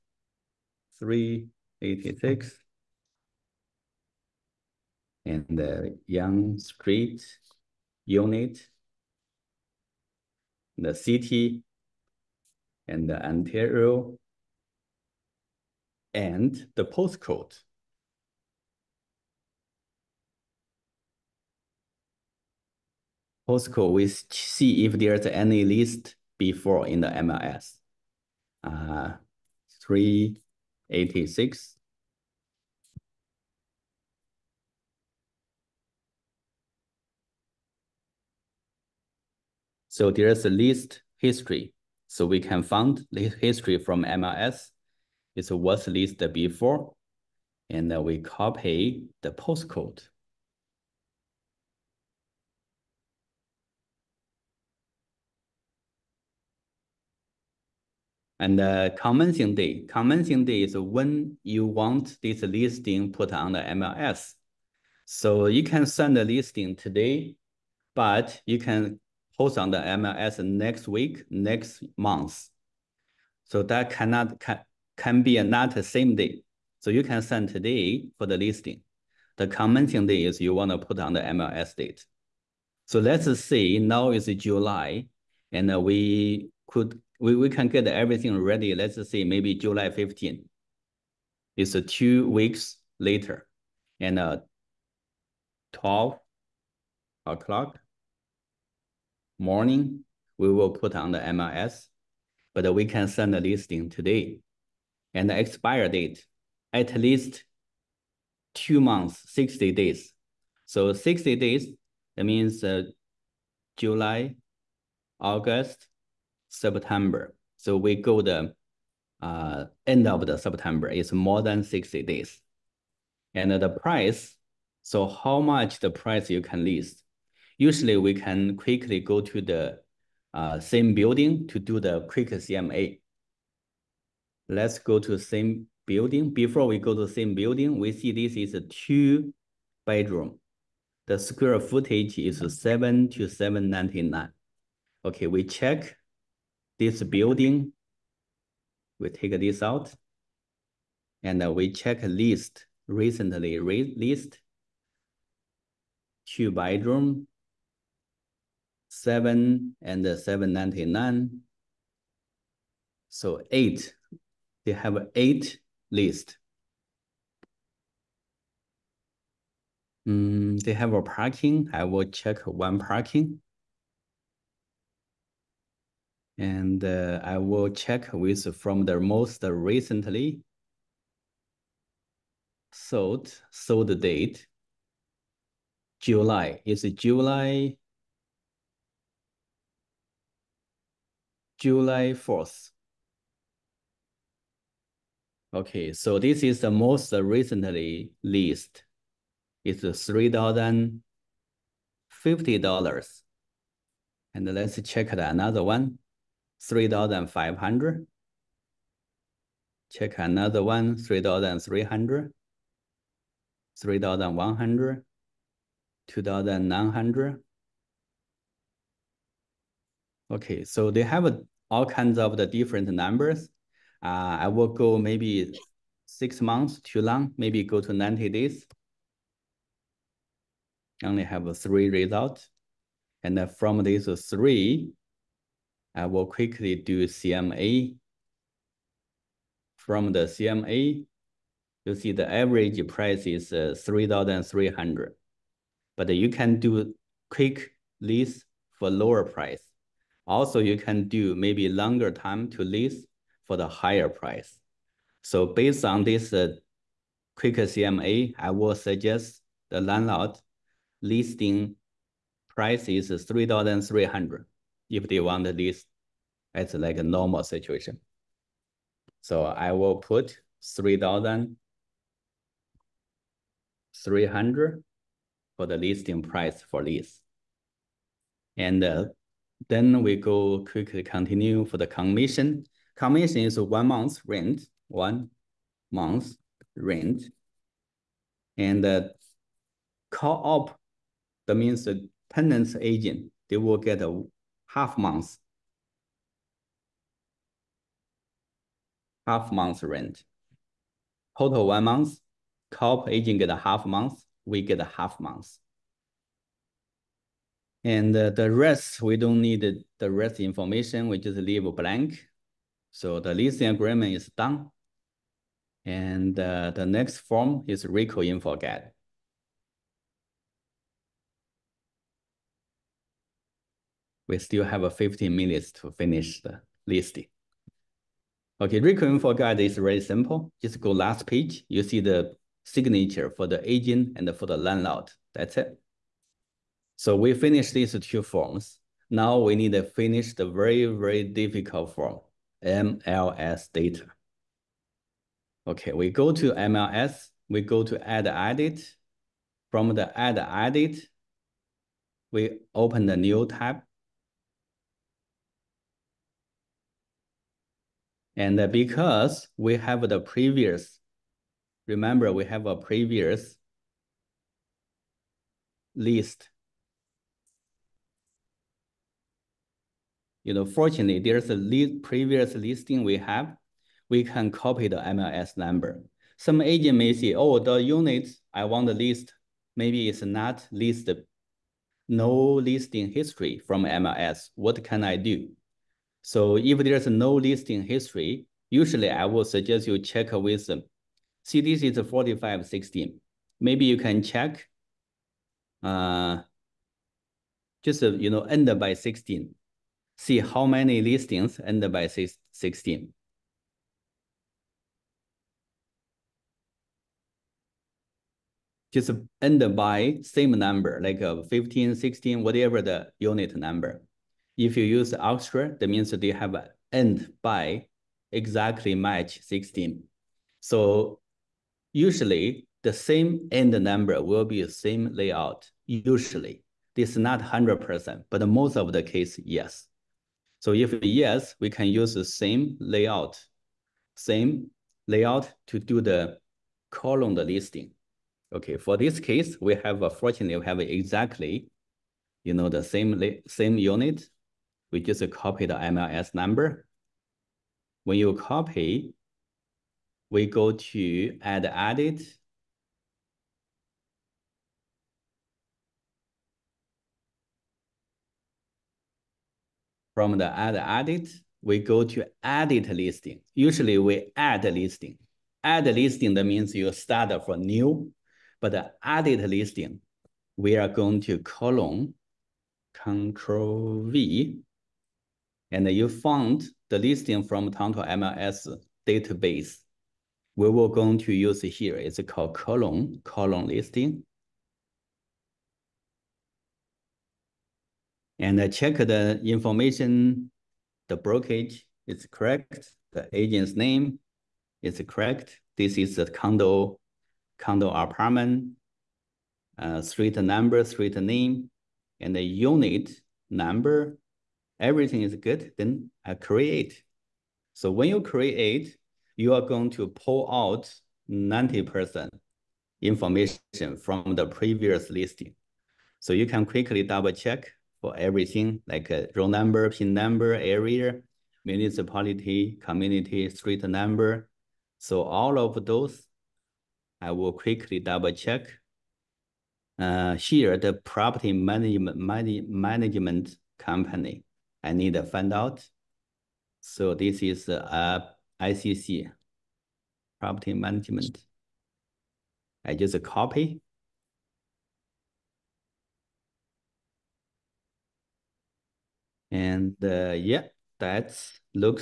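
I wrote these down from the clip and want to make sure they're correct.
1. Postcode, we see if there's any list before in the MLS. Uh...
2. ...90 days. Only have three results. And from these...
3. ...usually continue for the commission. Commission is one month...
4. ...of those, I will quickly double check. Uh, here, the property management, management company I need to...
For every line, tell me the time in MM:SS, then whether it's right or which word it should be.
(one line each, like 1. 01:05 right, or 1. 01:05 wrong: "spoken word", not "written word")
1. 00:23 right
2. 03:47 right
3. 04:40 wrong: "quickly", not "usually"
4. 08:45 right.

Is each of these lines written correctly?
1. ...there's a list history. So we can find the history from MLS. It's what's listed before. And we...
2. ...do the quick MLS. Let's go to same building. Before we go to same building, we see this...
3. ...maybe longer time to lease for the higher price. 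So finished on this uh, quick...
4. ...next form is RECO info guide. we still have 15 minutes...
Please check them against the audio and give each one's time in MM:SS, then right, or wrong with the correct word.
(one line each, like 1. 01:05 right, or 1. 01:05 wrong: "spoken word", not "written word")
1. 00:40 right
2. 02:11 wrong: "CMA", not "MLS"
3. 04:11 wrong: "based", not "finished"
4. 05:16 right.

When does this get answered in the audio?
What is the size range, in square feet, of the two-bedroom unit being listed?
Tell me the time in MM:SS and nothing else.
02:22.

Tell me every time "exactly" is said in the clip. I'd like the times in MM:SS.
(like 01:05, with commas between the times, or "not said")
06:58, 07:20.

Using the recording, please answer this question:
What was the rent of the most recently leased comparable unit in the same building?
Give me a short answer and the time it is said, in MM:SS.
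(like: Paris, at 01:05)
$3,050, at 03:19.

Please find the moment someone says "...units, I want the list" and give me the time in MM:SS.
06:17.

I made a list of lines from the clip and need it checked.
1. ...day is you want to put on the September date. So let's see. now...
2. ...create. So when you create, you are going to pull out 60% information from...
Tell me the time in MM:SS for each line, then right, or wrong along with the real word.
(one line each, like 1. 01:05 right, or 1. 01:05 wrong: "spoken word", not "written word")
1. 01:20 wrong: "MLS", not "September"
2. 08:26 wrong: "90", not "60".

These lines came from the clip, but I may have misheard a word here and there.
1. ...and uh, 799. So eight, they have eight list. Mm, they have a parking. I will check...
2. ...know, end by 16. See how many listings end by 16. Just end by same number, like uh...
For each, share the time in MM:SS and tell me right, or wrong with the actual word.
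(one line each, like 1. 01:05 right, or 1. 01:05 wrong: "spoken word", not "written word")
1. 02:39 right
2. 06:38 right.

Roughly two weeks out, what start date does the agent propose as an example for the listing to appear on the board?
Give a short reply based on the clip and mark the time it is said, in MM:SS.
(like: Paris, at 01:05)
July 15, at 01:29.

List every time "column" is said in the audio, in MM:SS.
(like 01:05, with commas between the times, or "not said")
07:16, 08:02.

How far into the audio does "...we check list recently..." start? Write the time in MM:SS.
02:31.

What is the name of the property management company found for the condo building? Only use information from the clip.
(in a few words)
ICC.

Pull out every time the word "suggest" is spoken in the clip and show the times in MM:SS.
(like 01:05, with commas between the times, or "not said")
04:18, 06:29.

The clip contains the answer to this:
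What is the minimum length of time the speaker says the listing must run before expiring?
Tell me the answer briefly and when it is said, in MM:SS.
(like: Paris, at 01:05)
60 days, at 01:46.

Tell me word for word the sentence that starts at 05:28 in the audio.
Okay, RECO info guide is really simple.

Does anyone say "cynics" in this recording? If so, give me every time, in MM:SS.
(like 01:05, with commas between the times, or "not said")
not said.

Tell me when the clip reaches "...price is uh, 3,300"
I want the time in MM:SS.
04:02.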